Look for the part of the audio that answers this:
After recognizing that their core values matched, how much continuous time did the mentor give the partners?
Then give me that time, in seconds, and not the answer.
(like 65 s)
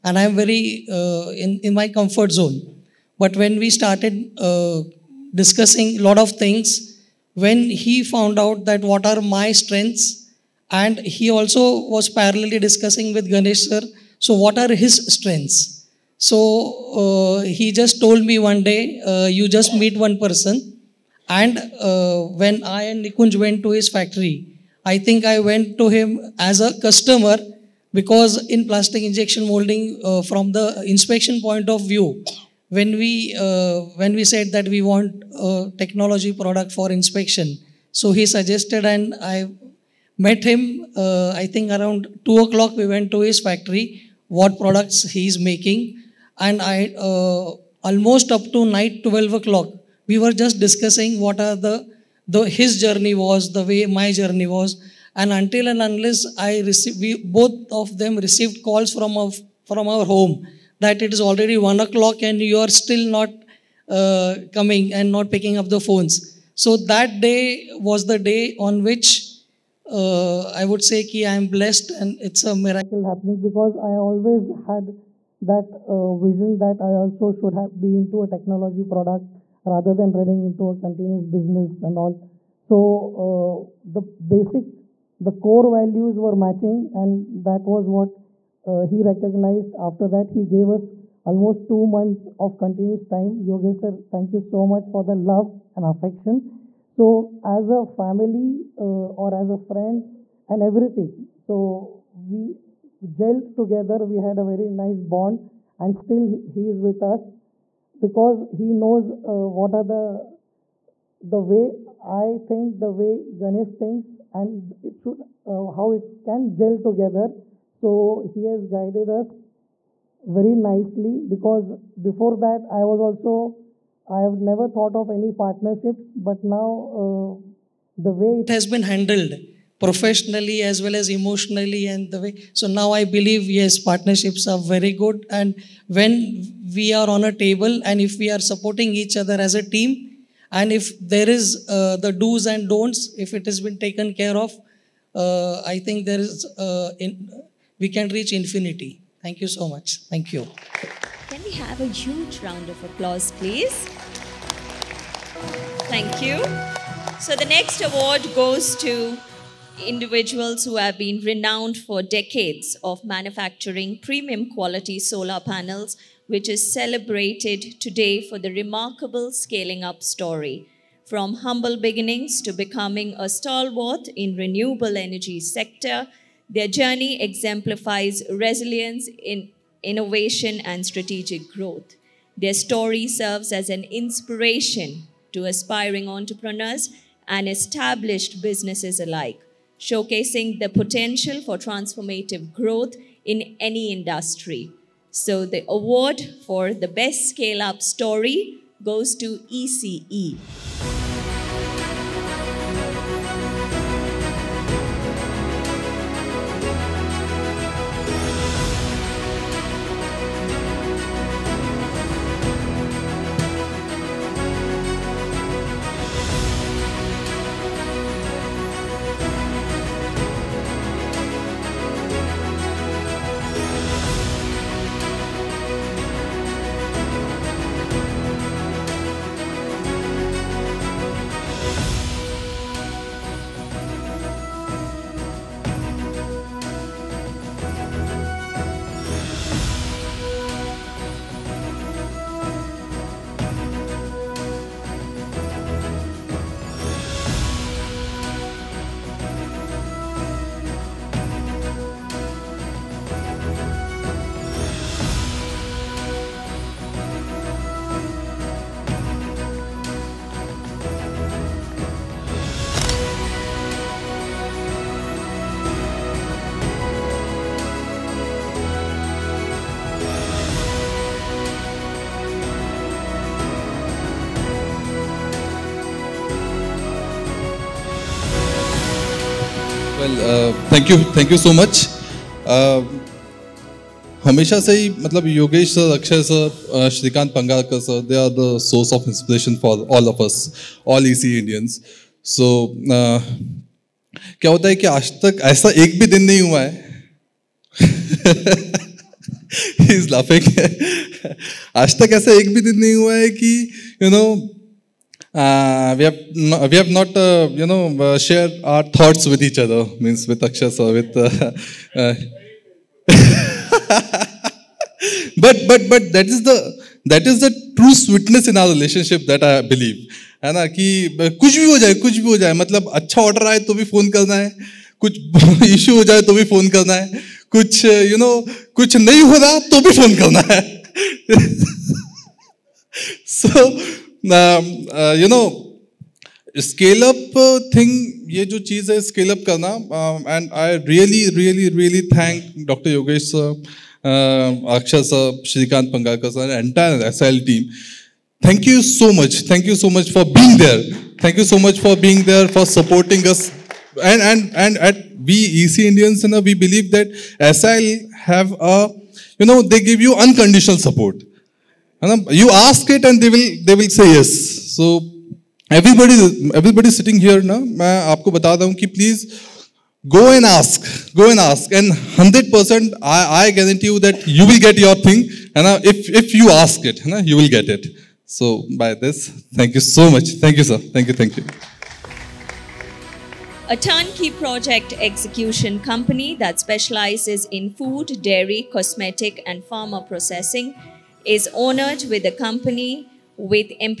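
91 s.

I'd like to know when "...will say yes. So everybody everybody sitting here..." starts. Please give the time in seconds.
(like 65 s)
363 s.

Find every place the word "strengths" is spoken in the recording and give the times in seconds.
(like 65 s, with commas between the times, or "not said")
9 s, 15 s.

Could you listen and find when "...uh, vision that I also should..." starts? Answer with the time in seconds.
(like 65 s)
75 s.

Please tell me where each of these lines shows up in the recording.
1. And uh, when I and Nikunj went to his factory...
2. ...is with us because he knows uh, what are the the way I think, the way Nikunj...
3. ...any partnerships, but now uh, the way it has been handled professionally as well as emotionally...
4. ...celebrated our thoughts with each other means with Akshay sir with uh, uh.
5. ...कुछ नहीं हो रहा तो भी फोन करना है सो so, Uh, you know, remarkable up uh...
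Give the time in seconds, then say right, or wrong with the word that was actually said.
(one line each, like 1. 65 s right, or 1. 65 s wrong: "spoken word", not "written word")
1. 21 s right
2. 106 s wrong: "Ganesh", not "Nikunj"
3. 125 s right
4. 308 s wrong: "shared", not "celebrated"
5. 328 s wrong: "scale", not "remarkable".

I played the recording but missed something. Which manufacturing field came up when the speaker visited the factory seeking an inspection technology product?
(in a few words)
plastic injection molding.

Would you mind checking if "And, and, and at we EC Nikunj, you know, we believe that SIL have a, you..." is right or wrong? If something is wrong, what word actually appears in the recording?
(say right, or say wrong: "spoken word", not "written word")
wrong: "Indians", not "Nikunj".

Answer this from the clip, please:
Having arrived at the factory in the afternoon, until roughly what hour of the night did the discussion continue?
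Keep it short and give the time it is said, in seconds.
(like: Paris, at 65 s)
12 o'clock, at 48 s.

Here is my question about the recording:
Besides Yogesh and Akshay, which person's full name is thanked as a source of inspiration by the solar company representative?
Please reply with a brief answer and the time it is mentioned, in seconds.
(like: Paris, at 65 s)
Shrikant Pangarkar, at 345 s.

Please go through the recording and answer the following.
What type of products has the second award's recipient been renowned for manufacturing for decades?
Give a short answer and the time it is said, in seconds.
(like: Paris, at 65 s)
solar panels, at 164 s.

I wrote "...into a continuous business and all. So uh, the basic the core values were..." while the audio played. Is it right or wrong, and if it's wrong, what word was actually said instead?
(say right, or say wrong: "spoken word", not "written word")
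right.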